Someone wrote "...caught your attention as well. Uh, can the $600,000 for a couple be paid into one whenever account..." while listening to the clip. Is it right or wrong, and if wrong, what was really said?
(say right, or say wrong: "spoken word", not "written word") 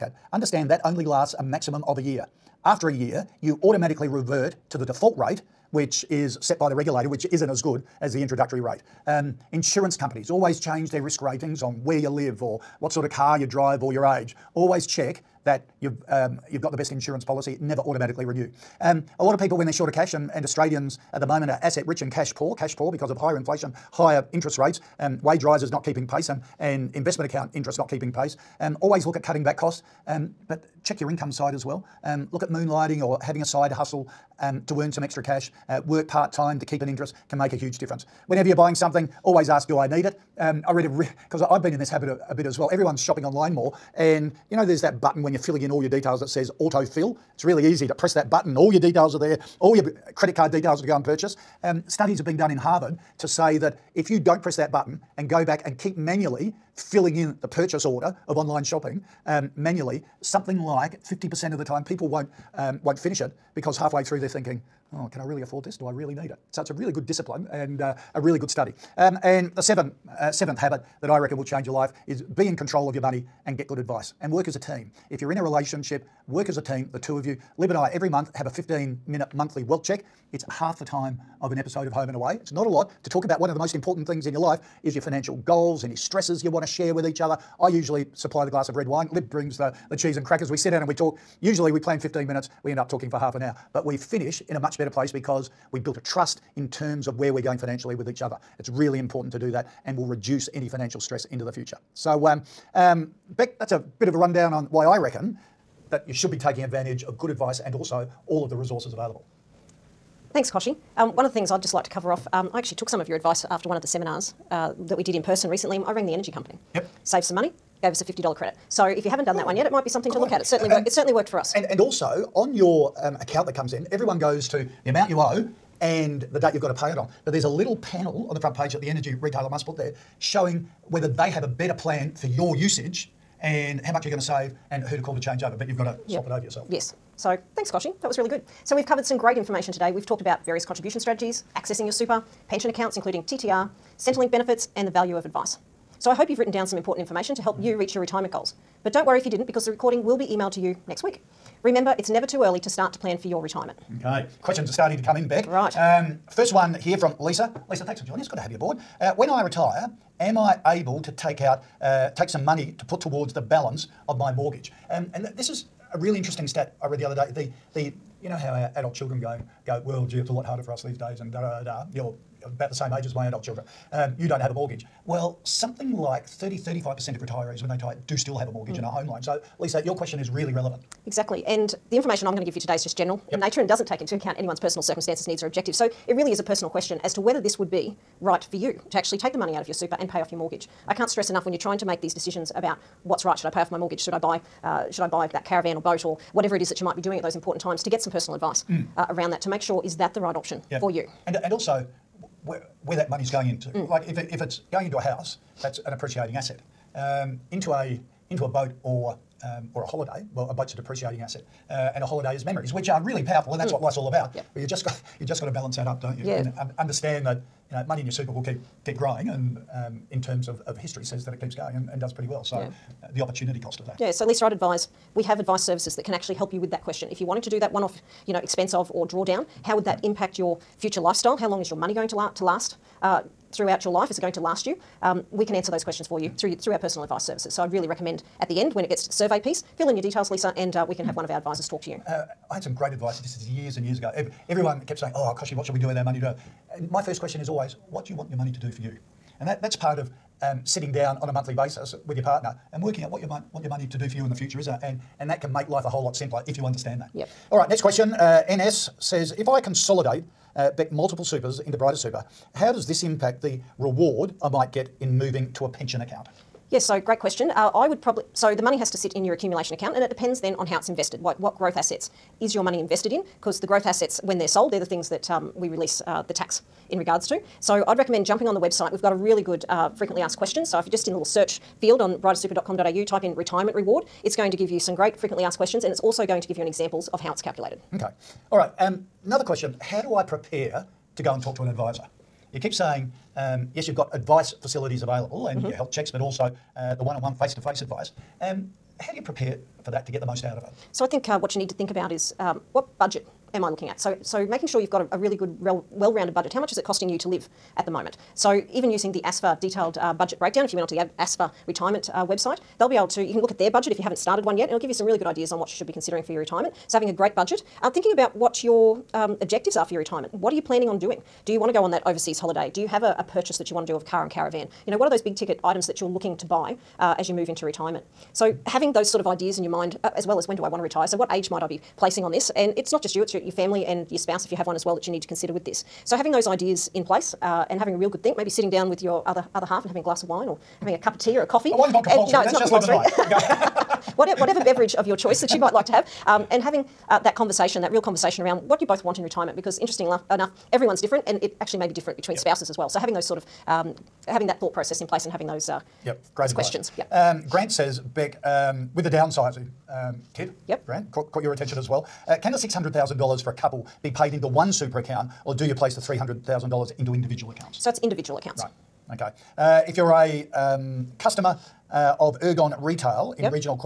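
wrong: "super", not "whenever".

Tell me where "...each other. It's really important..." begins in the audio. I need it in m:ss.
1:38.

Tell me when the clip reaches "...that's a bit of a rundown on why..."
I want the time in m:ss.
1:43.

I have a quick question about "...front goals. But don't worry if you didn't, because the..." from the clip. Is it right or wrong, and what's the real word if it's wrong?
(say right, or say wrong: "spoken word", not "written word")
wrong: "retirement", not "front".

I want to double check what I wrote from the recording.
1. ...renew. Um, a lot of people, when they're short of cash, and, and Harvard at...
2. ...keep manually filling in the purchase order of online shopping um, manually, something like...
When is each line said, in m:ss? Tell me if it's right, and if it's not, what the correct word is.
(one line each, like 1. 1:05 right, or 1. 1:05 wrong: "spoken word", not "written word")
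1. 0:18 wrong: "Australians", not "Harvard"
2. 0:55 right.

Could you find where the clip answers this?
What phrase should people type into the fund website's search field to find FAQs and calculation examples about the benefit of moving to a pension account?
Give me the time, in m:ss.
4:43.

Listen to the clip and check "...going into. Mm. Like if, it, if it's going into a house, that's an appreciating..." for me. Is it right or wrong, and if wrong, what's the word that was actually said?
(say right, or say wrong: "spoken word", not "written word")
right.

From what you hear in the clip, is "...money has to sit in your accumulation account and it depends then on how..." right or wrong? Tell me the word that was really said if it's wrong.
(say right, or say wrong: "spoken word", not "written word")
right.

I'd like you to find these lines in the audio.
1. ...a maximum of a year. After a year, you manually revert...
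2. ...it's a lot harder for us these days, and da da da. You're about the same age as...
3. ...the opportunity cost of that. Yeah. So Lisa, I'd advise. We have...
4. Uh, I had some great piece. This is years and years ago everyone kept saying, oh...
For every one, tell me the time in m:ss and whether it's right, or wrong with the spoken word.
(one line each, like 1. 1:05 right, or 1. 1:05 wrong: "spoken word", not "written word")
1. 0:01 wrong: "automatically", not "manually"
2. 2:50 right
3. 3:43 right
4. 4:02 wrong: "advice", not "piece".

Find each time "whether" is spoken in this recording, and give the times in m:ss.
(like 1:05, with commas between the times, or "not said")
2:10, 3:07.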